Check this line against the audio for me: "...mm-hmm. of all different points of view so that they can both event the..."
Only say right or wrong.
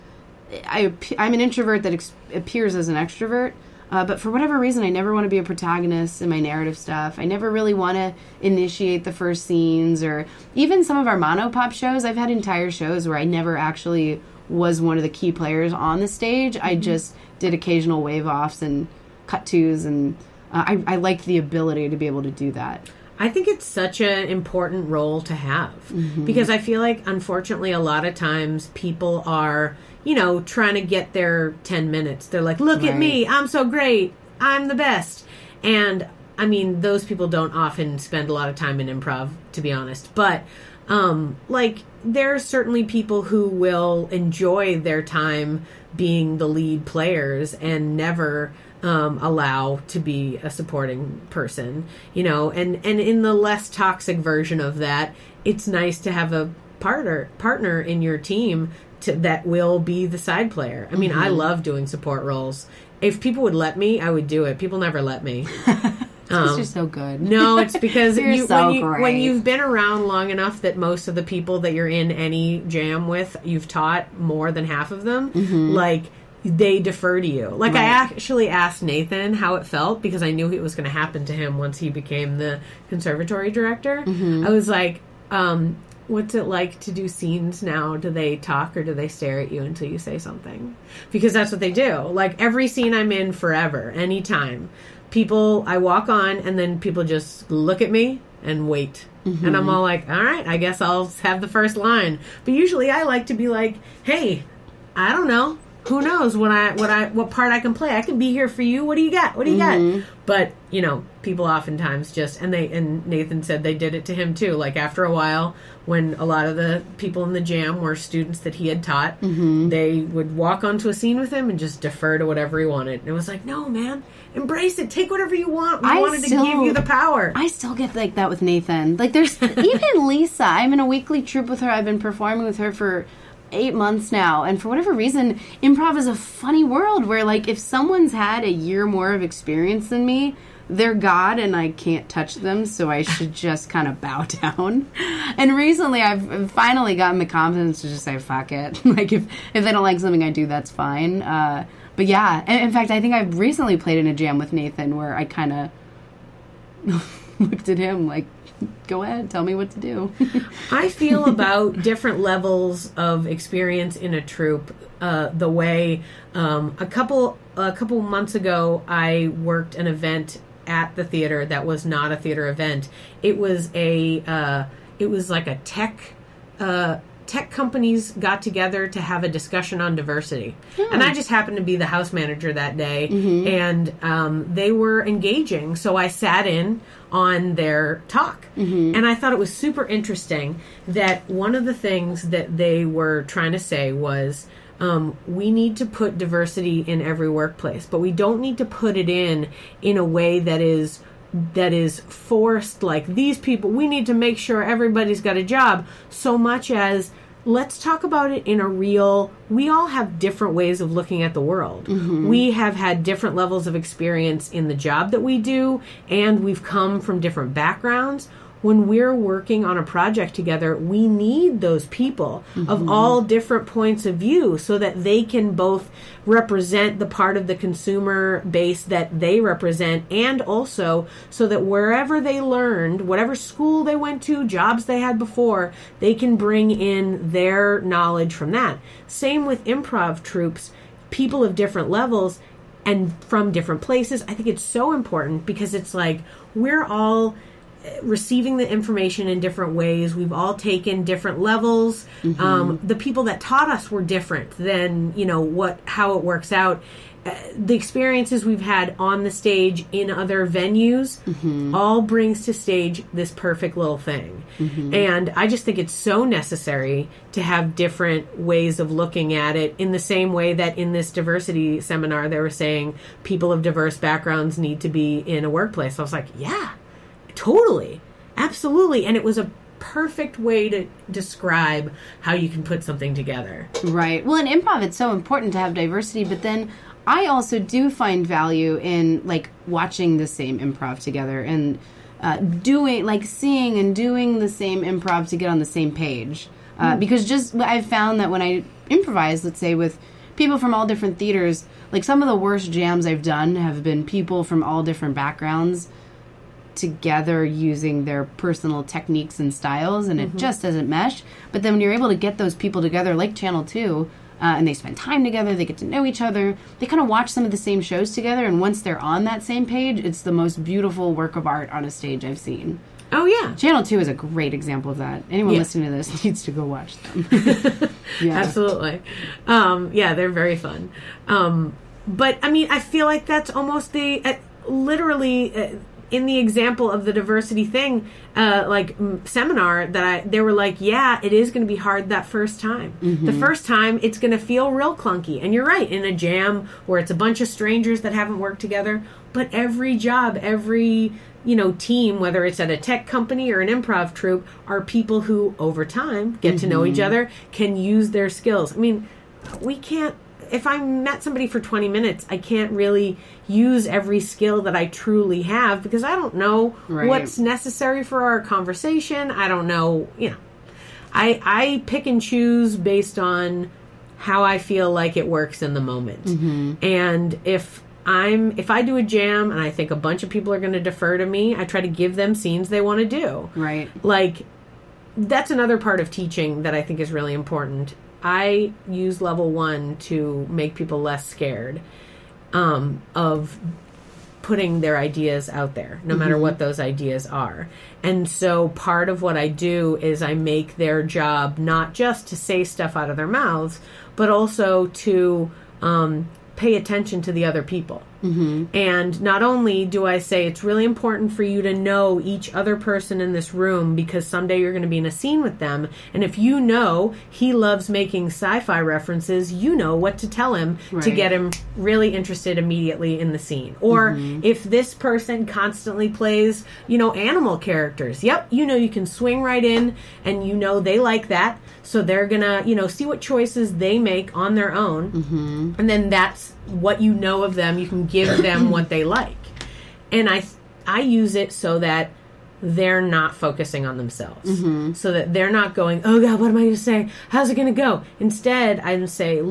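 wrong.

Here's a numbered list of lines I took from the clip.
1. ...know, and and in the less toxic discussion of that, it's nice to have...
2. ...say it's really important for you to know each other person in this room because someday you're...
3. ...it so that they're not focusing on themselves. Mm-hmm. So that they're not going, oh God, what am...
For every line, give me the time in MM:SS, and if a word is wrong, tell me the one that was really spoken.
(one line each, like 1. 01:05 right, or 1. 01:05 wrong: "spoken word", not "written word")
1. 00:52 wrong: "version", not "discussion"
2. 06:50 right
3. 07:21 right.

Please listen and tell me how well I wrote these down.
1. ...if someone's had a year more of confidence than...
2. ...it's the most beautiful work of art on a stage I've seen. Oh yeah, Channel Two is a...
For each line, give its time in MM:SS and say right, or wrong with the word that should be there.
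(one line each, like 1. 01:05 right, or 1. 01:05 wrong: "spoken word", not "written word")
1. 02:17 wrong: "experience", not "confidence"
2. 05:19 right.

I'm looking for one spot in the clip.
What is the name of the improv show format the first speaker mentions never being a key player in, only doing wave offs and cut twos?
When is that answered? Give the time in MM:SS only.
00:11.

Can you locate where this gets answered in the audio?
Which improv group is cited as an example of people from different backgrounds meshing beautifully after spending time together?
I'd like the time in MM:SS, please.
05:13.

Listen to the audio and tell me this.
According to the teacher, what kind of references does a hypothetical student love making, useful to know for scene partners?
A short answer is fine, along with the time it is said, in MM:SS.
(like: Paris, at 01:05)
sci fi, at 06:58.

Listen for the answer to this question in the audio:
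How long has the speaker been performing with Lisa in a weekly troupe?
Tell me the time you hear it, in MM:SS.
02:13.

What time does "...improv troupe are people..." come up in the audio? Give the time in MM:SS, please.
05:53.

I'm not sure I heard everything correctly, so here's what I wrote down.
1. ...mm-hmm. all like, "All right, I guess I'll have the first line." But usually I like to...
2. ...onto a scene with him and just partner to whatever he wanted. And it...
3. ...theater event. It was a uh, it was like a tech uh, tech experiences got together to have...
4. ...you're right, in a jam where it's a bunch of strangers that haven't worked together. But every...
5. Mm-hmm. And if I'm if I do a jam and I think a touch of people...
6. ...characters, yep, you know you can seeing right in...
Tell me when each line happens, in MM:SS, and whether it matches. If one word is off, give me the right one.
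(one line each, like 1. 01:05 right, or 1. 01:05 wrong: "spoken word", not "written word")
1. 01:39 right
2. 02:00 wrong: "defer", not "partner"
3. 02:52 wrong: "companies", not "experiences"
4. 05:45 right
5. 06:16 wrong: "bunch", not "touch"
6. 07:07 wrong: "swing", not "seeing".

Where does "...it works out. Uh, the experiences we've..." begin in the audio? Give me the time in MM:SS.
04:16.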